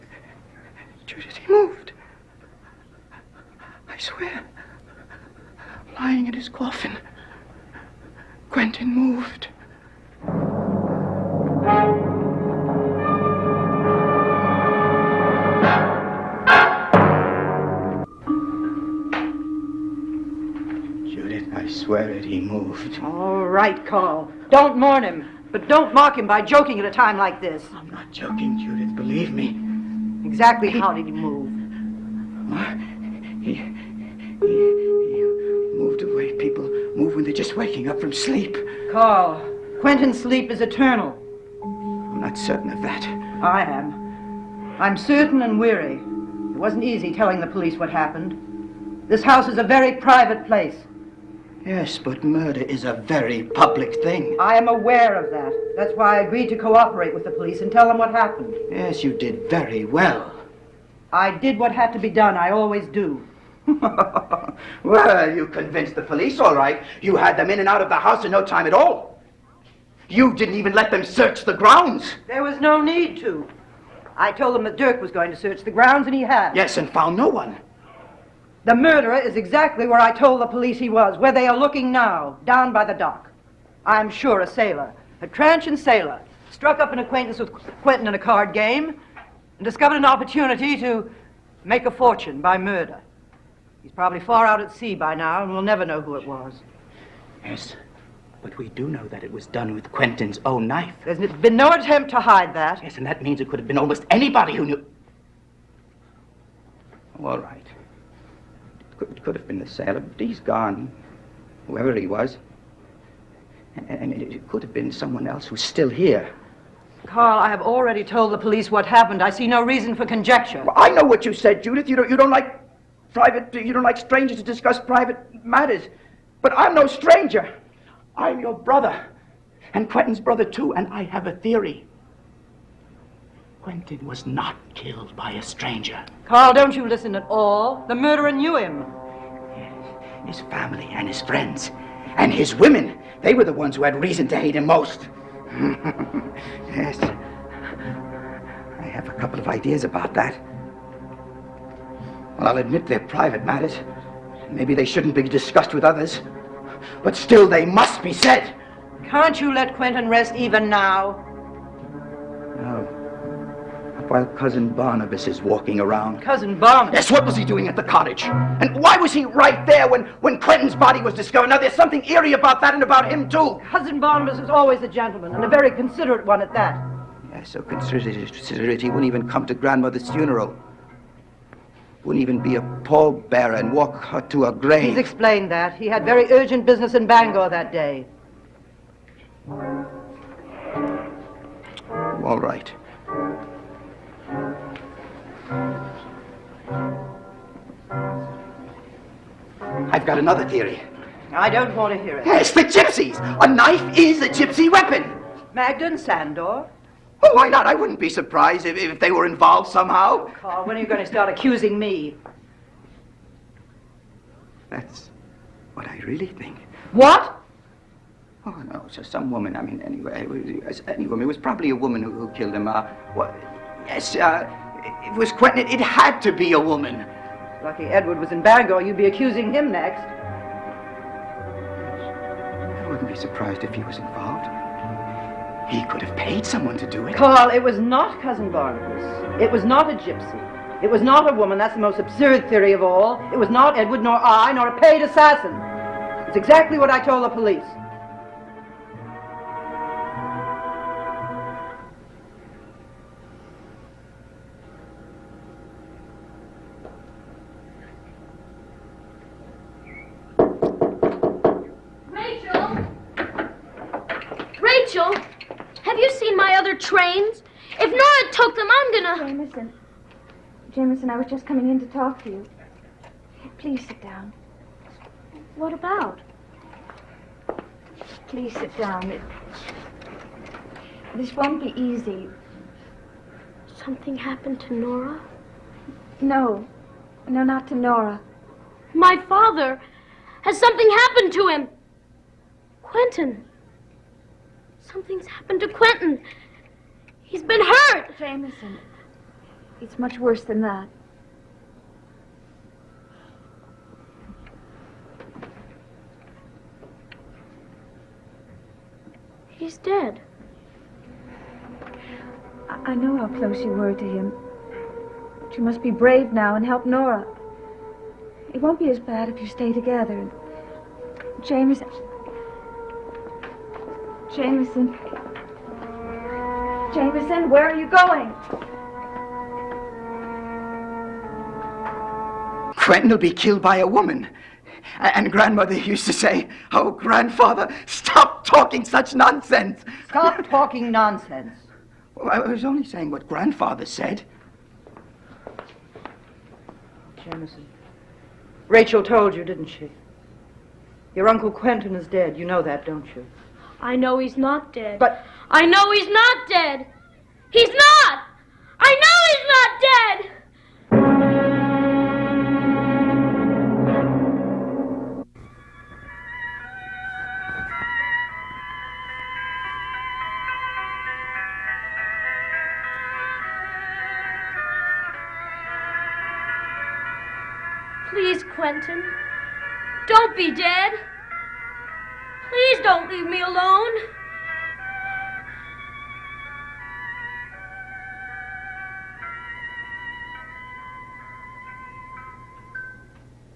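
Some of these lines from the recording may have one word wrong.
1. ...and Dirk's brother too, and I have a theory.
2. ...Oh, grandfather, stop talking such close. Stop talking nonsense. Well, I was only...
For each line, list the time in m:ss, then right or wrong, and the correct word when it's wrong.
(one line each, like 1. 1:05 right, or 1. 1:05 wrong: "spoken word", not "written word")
1. 2:09 wrong: "Quentin", not "Dirk"
2. 5:36 wrong: "nonsense", not "close".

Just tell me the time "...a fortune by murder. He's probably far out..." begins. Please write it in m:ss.
1:31.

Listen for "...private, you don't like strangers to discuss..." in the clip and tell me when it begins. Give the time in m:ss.
2:03.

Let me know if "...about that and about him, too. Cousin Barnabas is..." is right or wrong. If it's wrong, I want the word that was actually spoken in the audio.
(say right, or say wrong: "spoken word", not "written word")
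right.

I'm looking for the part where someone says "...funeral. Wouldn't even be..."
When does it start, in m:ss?
3:00.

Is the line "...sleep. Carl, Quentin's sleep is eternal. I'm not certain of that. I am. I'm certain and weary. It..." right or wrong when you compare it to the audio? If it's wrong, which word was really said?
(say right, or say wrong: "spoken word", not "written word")
right.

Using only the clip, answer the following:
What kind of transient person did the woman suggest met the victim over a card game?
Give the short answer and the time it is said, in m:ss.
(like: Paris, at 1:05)
A sailor, at 1:25.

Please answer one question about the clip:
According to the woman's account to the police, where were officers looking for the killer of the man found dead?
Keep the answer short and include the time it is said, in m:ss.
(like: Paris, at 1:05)
Down by the dock, at 1:22.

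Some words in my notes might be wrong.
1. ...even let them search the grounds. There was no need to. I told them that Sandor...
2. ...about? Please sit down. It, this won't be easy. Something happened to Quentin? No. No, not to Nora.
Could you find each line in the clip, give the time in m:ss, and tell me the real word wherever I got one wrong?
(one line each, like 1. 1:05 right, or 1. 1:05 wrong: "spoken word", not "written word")
1. 1:10 wrong: "Dirk", not "Sandor"
2. 4:35 wrong: "Nora", not "Quentin".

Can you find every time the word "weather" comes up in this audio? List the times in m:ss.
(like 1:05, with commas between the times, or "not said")
not said.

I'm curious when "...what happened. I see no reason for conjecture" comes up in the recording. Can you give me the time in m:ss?
1:58.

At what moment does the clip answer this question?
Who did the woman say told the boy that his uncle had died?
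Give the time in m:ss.
5:48.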